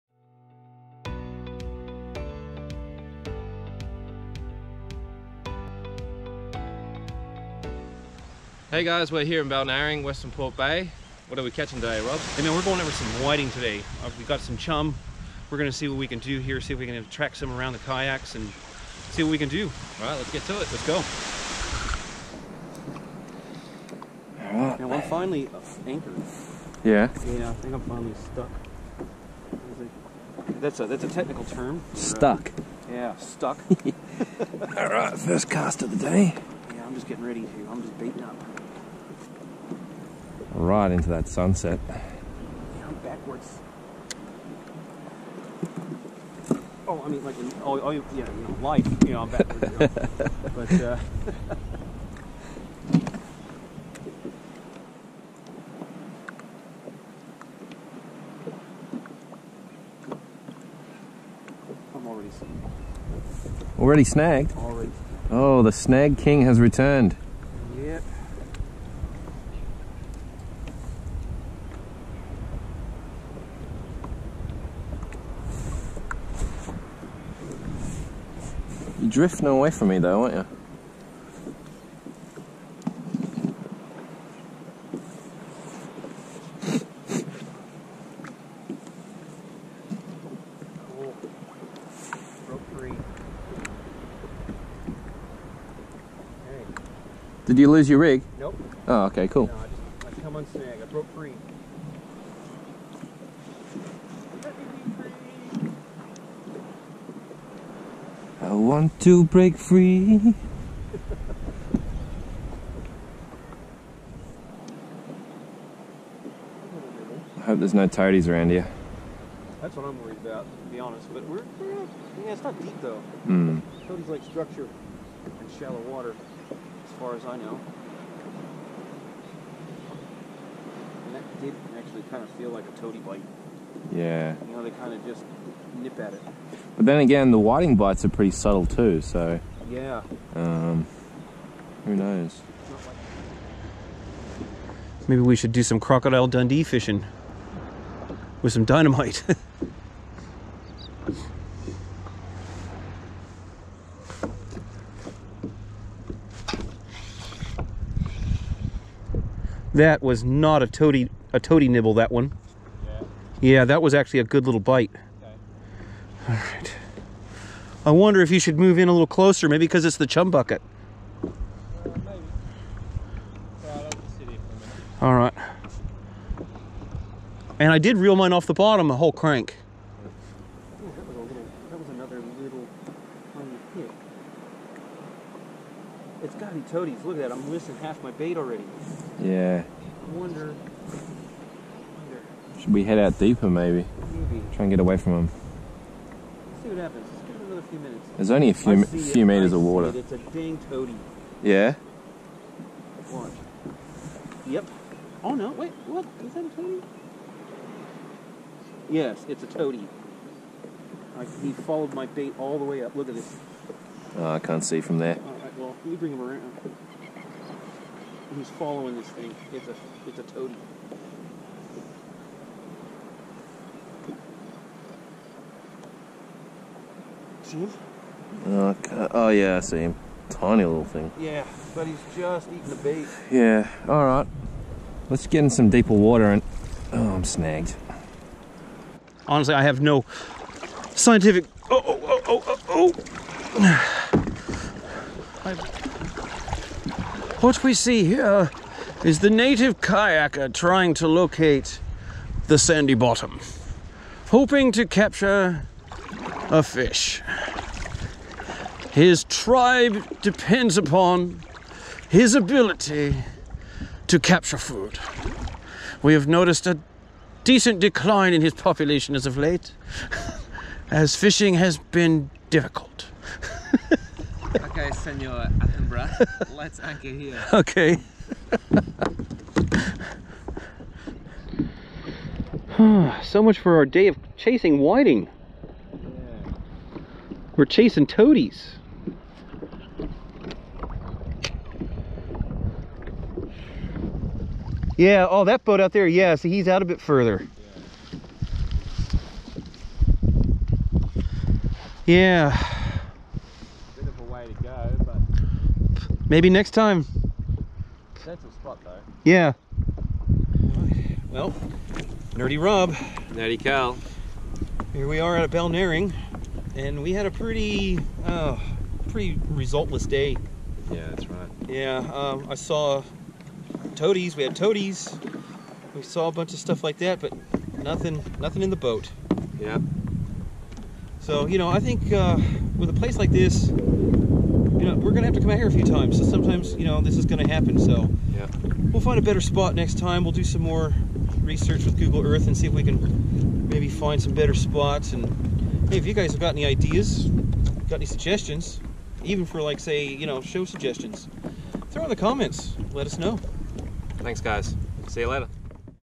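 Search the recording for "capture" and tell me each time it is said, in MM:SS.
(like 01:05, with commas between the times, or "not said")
04:14, 04:24.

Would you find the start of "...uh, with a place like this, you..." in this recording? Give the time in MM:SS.
05:32.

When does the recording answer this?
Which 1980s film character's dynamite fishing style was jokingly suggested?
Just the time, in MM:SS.
02:25.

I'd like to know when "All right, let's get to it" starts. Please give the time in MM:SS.
00:19.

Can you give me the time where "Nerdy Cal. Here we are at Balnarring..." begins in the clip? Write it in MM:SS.
05:13.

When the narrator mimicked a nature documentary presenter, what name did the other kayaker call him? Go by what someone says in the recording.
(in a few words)
Senor Attenborough.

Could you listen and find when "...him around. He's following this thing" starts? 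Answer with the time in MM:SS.
03:36.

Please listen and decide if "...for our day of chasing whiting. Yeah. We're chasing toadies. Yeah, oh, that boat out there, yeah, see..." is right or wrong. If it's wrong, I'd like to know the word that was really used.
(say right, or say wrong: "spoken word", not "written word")
right.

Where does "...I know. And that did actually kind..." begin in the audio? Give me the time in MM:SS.
02:07.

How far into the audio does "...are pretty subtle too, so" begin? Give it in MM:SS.
02:18.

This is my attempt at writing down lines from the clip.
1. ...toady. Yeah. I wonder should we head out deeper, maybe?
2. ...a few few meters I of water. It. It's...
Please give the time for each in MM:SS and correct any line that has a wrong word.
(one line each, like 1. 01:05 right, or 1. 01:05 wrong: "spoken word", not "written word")
1. 03:08 wrong: "already", not "toady"
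2. 03:18 right.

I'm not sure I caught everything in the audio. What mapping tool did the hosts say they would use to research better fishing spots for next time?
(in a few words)
Google Earth.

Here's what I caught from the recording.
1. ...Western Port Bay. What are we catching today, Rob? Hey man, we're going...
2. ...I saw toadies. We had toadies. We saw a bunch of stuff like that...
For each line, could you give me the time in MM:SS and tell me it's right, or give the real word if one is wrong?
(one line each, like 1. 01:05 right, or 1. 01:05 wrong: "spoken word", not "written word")
1. 00:10 right
2. 05:22 right.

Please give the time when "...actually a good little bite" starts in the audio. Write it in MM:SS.
02:43.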